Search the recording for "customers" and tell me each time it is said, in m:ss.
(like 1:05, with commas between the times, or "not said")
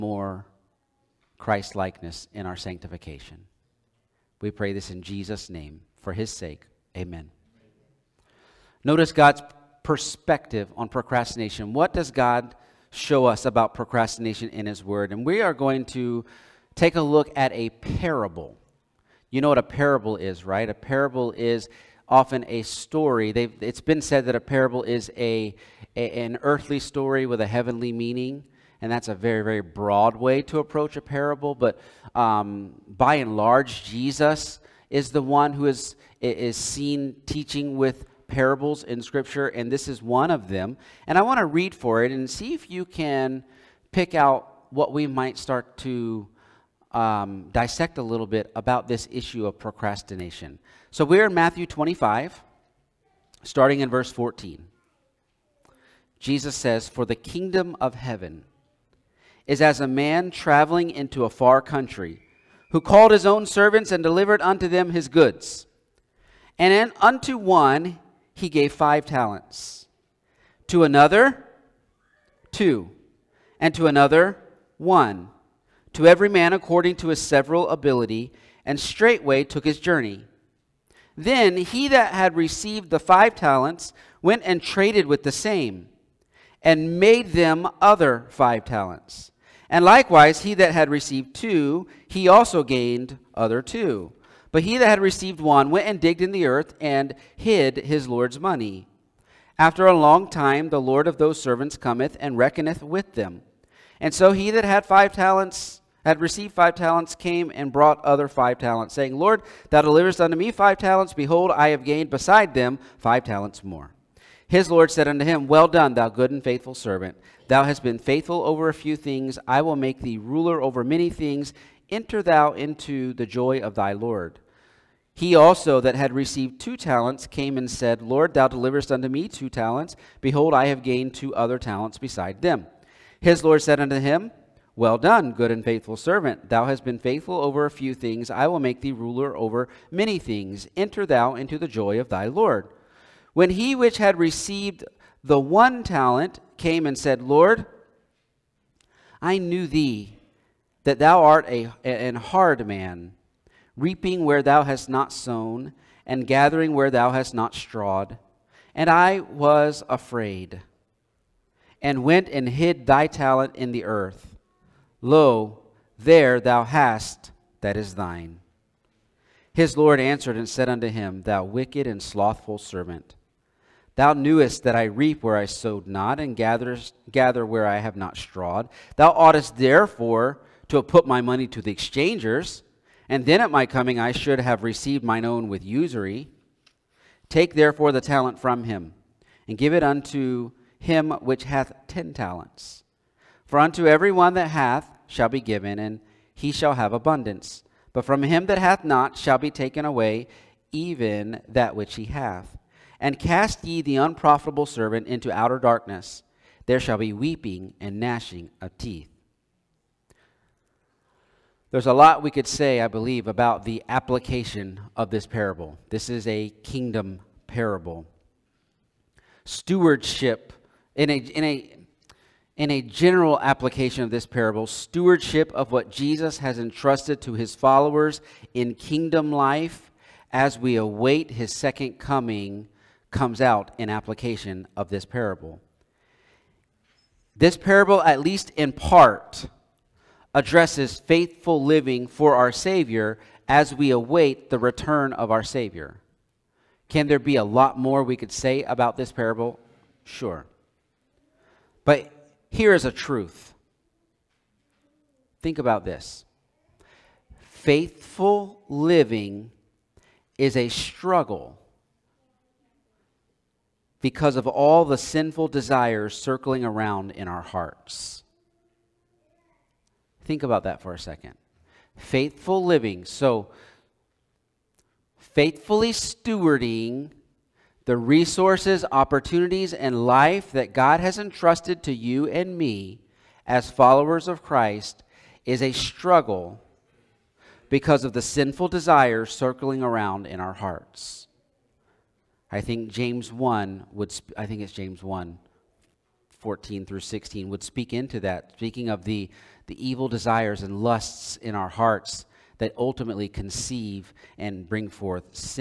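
not said.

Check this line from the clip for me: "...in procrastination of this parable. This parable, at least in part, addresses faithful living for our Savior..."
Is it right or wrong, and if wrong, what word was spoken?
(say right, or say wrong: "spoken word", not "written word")
wrong: "application", not "procrastination".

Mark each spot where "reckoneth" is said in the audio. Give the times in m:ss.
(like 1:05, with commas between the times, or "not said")
1:42.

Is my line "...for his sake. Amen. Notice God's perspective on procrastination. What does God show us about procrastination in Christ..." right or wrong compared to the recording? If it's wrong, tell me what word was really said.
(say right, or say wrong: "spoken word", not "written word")
wrong: "His", not "Christ".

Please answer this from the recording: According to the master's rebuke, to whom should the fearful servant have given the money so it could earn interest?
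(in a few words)
the exchangers.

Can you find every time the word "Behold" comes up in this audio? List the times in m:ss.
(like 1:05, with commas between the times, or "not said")
1:51, 2:10.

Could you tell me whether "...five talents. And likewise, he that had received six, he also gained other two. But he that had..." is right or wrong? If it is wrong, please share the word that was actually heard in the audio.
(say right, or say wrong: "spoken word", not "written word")
wrong: "two", not "six".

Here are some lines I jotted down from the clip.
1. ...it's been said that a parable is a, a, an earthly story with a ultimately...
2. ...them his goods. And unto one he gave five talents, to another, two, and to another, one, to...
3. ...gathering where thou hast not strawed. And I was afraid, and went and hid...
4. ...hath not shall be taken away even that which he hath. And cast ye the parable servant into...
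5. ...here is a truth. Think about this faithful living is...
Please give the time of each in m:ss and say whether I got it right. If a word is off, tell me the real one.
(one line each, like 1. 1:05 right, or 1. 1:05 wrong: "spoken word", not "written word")
1. 0:23 wrong: "heavenly", not "ultimately"
2. 1:04 right
3. 2:36 right
4. 3:18 wrong: "unprofitable", not "parable"
5. 4:12 right.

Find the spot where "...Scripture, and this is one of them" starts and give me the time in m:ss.
0:39.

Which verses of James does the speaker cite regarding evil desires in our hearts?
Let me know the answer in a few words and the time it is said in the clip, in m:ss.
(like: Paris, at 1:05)
1:14-16, at 4:54.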